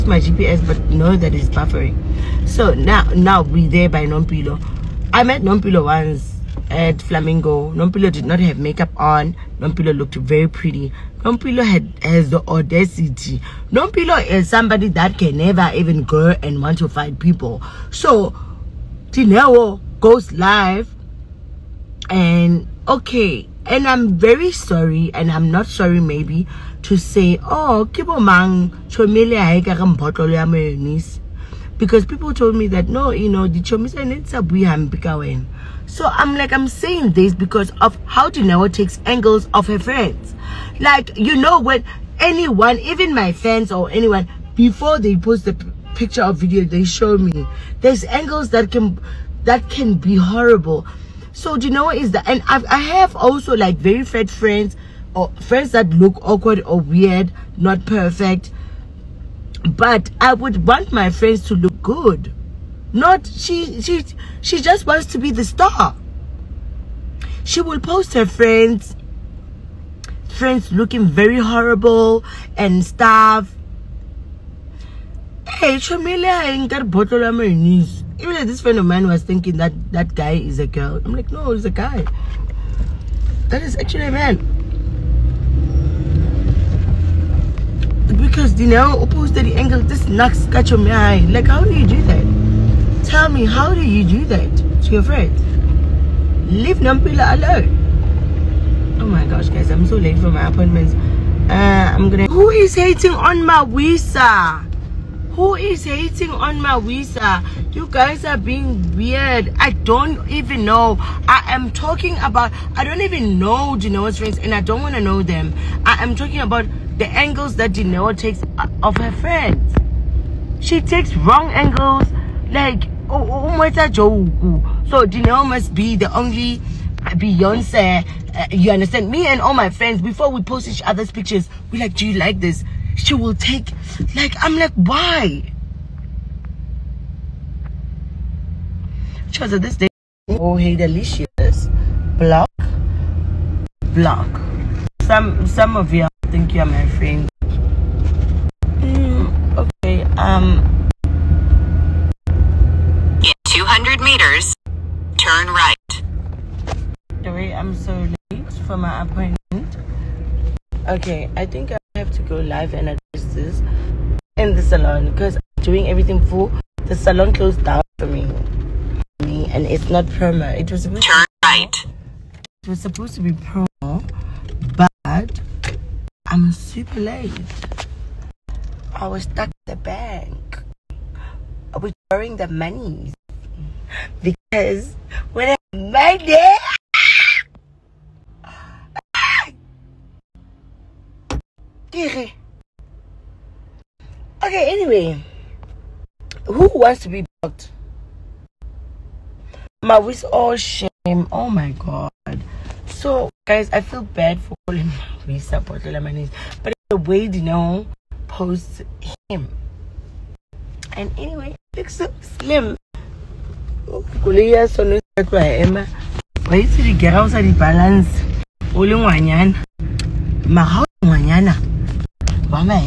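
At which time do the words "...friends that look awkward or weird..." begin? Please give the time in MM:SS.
00:55.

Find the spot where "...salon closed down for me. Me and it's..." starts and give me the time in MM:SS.
02:46.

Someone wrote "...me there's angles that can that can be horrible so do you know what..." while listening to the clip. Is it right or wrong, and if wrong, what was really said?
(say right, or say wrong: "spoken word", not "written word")
right.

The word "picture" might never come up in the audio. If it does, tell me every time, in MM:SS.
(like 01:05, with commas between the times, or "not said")
00:45, 02:11.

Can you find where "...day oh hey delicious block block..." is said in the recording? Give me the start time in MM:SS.
02:19.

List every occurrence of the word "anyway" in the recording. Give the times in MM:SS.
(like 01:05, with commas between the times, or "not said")
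03:14, 03:31.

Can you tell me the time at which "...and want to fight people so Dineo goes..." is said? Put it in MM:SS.
00:16.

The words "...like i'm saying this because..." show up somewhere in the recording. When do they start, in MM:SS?
00:36.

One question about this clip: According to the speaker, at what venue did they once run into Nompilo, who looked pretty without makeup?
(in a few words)
Flamingo.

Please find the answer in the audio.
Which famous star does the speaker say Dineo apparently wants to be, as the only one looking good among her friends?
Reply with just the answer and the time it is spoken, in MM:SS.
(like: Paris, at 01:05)
Beyonce, at 02:07.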